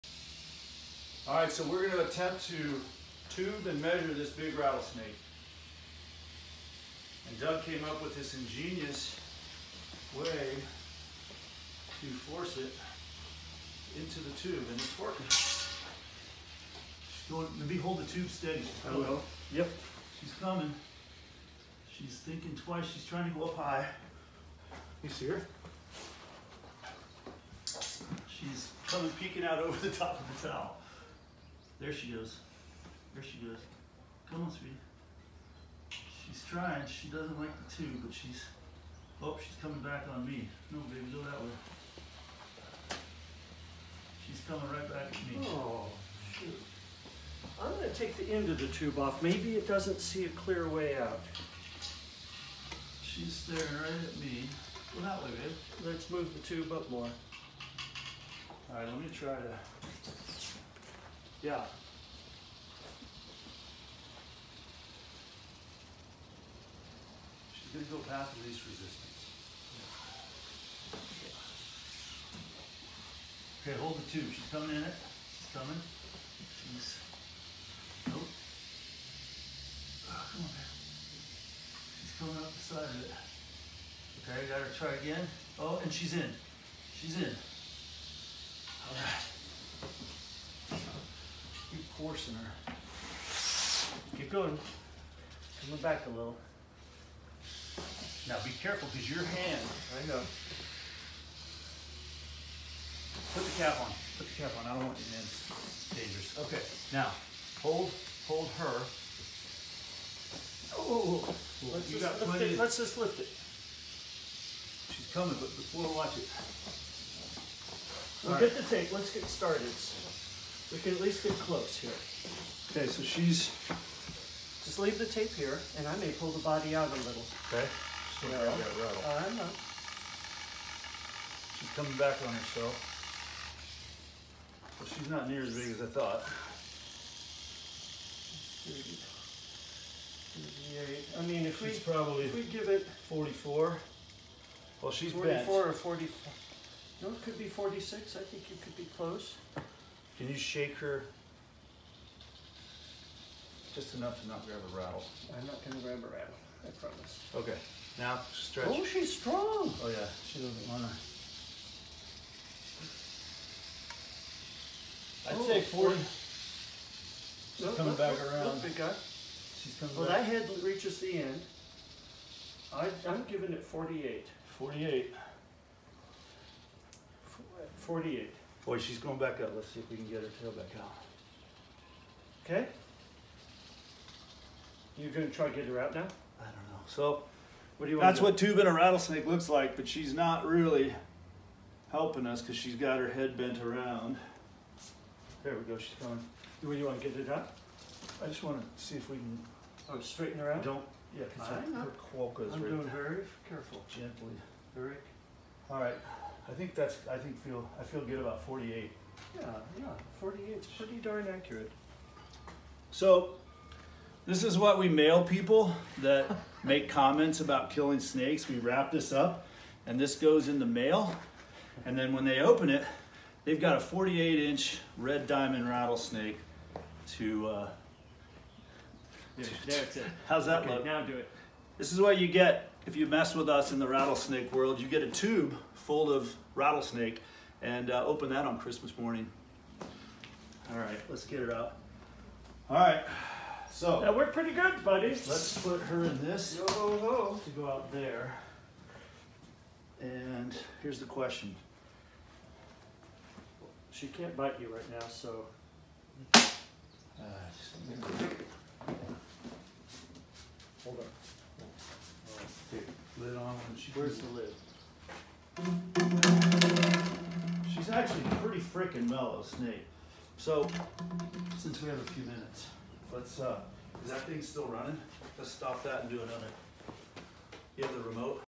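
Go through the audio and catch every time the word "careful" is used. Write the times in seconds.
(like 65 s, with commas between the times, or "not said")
98 s, 203 s.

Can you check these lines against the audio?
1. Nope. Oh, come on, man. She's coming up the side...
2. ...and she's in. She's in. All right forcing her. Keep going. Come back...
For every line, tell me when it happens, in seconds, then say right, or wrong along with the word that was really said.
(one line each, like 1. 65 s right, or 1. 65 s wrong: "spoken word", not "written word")
1. 78 s right
2. 85 s right.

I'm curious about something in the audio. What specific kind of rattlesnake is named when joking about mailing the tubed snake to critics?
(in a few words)
red diamond rattlesnake.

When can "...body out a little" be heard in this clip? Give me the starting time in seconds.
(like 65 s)
126 s.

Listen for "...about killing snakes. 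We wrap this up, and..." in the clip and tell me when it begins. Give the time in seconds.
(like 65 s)
217 s.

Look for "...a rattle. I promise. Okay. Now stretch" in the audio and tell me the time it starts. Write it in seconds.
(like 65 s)
155 s.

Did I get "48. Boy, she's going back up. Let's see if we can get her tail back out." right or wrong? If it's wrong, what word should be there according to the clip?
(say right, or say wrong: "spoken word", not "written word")
right.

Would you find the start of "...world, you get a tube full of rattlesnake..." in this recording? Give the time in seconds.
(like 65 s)
234 s.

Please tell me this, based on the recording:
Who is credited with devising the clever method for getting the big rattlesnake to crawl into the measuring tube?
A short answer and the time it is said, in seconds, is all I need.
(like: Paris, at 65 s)
Doug, at 7 s.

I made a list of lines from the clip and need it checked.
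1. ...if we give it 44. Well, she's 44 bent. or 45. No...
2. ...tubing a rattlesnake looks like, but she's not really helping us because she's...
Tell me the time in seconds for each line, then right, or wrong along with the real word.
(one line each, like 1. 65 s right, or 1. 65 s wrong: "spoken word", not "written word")
1. 142 s right
2. 188 s right.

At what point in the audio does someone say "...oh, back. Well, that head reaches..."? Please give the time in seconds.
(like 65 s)
170 s.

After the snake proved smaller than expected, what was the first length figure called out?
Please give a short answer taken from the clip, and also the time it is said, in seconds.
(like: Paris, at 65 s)
38, at 138 s.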